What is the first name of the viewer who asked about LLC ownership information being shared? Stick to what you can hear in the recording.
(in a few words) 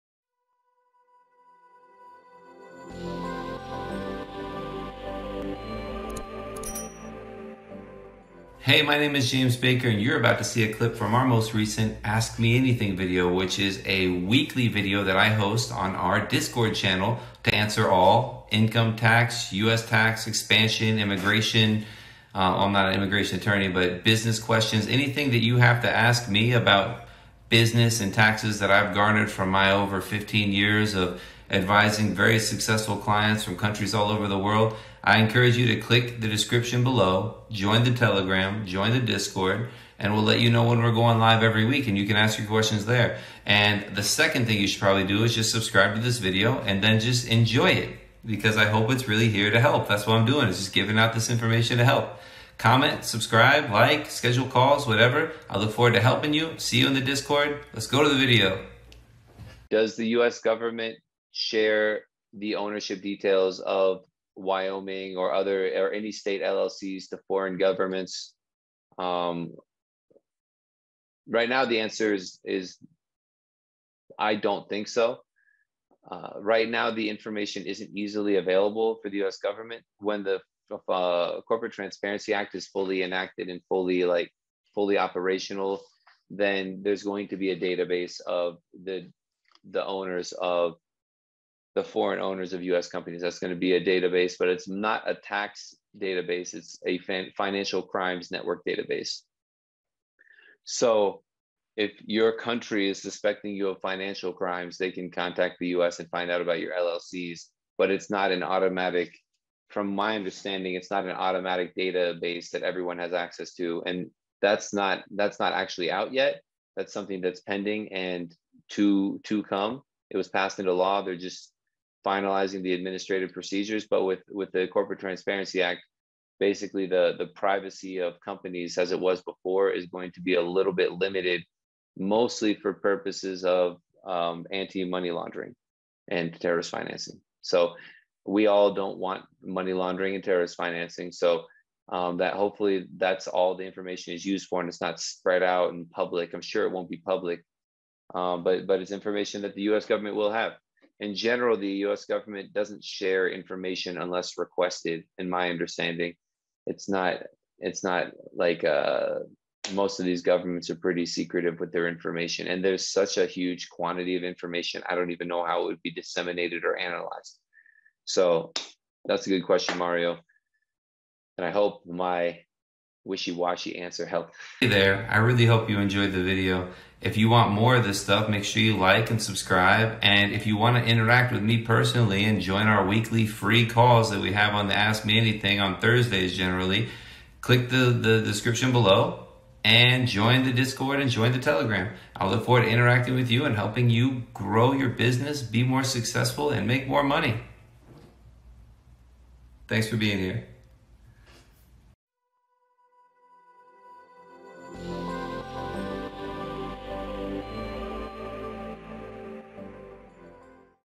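Mario.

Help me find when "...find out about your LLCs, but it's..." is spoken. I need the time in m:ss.
1:46.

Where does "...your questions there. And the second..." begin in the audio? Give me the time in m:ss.
0:42.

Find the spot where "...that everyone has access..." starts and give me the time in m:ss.
1:52.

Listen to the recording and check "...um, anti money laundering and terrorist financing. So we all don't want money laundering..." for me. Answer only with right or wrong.
right.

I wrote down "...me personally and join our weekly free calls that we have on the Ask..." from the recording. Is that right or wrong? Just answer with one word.
right.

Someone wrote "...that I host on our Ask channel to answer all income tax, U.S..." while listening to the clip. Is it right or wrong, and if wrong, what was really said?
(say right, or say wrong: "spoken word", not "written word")
wrong: "Discord", not "Ask".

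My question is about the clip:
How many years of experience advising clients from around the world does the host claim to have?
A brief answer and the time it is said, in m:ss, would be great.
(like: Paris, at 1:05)
15, at 0:30.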